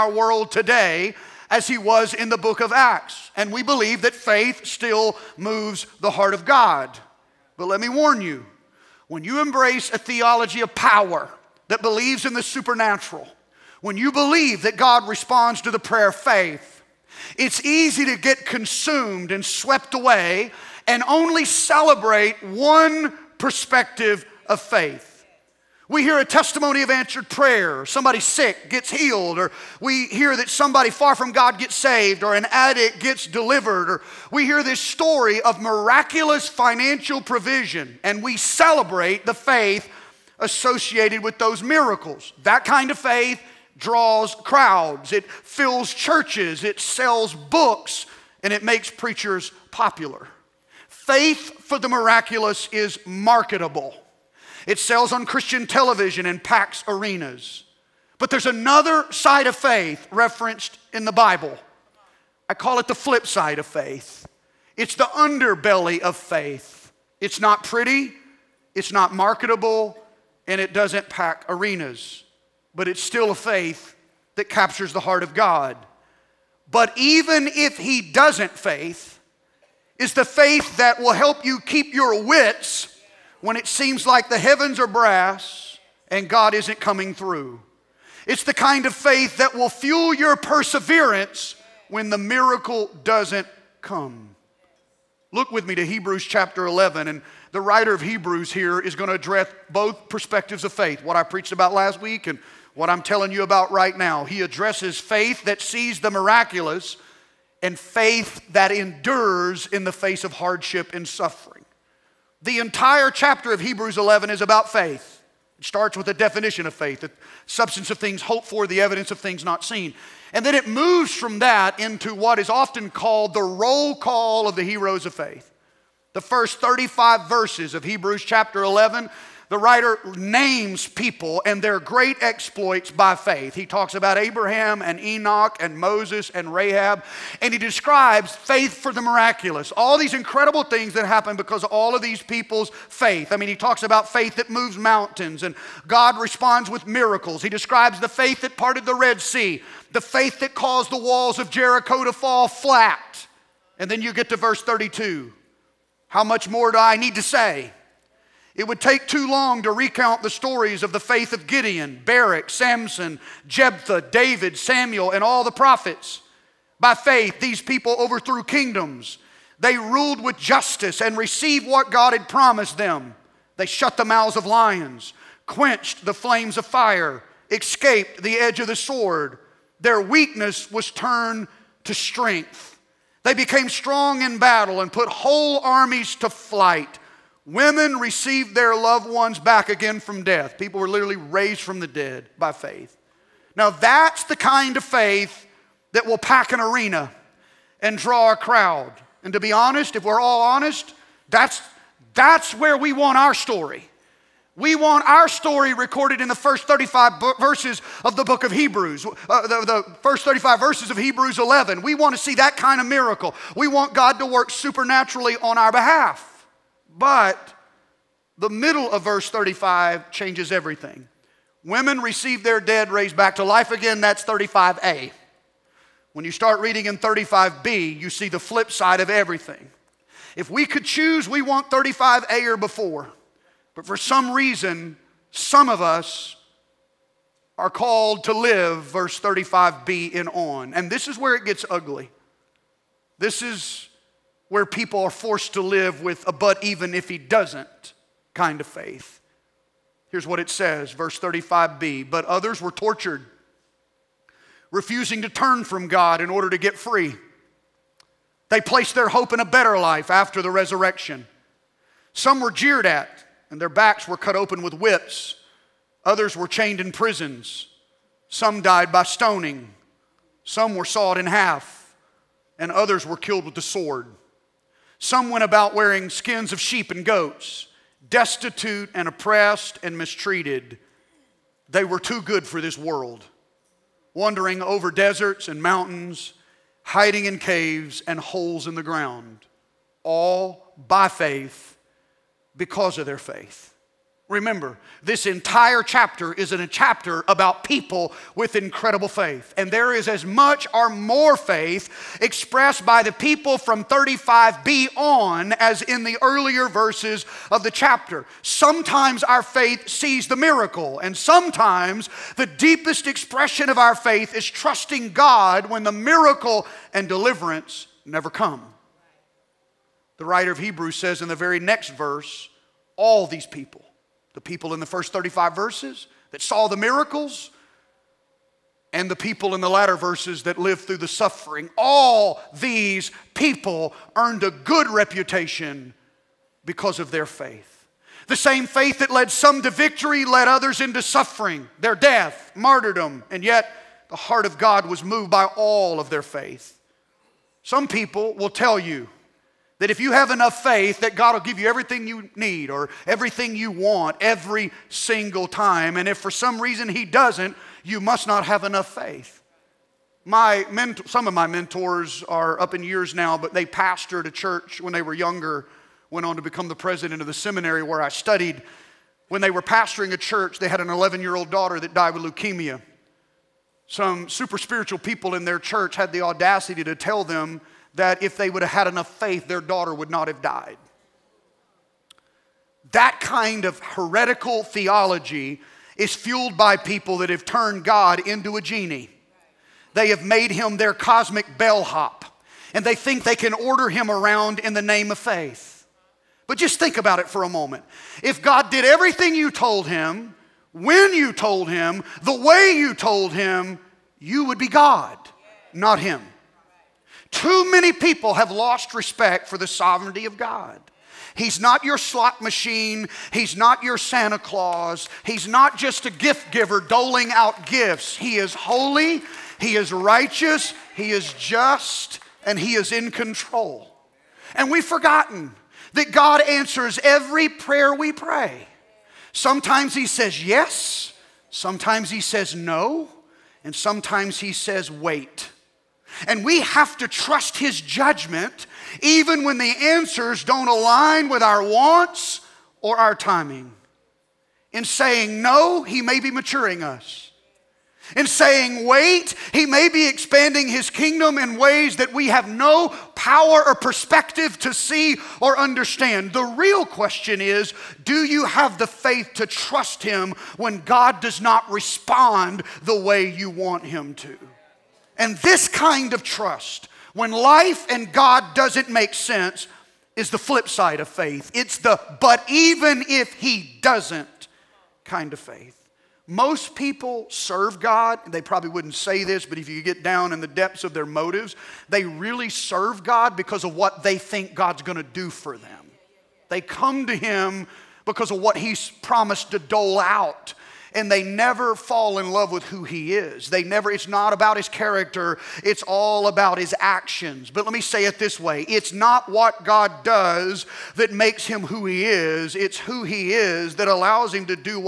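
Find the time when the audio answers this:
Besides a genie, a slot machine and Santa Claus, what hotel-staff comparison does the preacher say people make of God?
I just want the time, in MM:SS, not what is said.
06:30.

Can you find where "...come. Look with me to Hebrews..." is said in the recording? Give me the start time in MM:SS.
01:33.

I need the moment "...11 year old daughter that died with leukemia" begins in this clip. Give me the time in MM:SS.
06:10.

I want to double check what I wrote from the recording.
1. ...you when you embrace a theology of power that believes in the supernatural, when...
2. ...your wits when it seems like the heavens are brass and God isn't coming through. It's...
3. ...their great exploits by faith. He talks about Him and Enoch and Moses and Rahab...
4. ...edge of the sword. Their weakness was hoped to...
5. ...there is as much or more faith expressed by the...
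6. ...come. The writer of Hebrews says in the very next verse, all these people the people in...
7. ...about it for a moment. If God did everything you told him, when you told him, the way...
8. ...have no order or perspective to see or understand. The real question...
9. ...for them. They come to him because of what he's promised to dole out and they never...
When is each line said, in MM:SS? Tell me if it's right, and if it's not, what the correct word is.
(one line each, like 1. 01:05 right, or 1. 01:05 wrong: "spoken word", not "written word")
1. 00:08 right
2. 01:21 right
3. 02:11 wrong: "Abraham", not "Him"
4. 02:58 wrong: "turned", not "hoped"
5. 04:59 right
6. 05:18 right
7. 06:36 right
8. 07:32 wrong: "power", not "order"
9. 08:05 right.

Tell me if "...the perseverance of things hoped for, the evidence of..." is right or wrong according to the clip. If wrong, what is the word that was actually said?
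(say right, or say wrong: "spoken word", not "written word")
wrong: "substance", not "perseverance".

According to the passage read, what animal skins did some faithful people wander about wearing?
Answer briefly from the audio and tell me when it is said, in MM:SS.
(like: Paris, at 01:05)
sheep and goats, at 04:36.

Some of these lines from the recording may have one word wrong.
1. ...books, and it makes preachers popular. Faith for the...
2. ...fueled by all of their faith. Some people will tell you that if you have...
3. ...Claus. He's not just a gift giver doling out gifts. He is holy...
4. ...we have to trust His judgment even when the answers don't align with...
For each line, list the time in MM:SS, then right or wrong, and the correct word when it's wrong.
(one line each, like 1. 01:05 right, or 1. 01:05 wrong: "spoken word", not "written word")
1. 00:47 right
2. 05:45 wrong: "moved", not "fueled"
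3. 06:54 right
4. 07:16 right.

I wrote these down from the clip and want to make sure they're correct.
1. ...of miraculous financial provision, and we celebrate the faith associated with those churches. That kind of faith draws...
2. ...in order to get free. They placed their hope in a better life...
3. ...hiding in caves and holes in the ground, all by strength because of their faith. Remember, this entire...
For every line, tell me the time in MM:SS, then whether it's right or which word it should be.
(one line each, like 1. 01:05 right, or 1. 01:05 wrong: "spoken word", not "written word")
1. 00:35 wrong: "miracles", not "churches"
2. 04:16 right
3. 04:46 wrong: "faith", not "strength".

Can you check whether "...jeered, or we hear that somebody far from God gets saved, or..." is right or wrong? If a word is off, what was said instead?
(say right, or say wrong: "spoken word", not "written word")
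wrong: "healed", not "jeered".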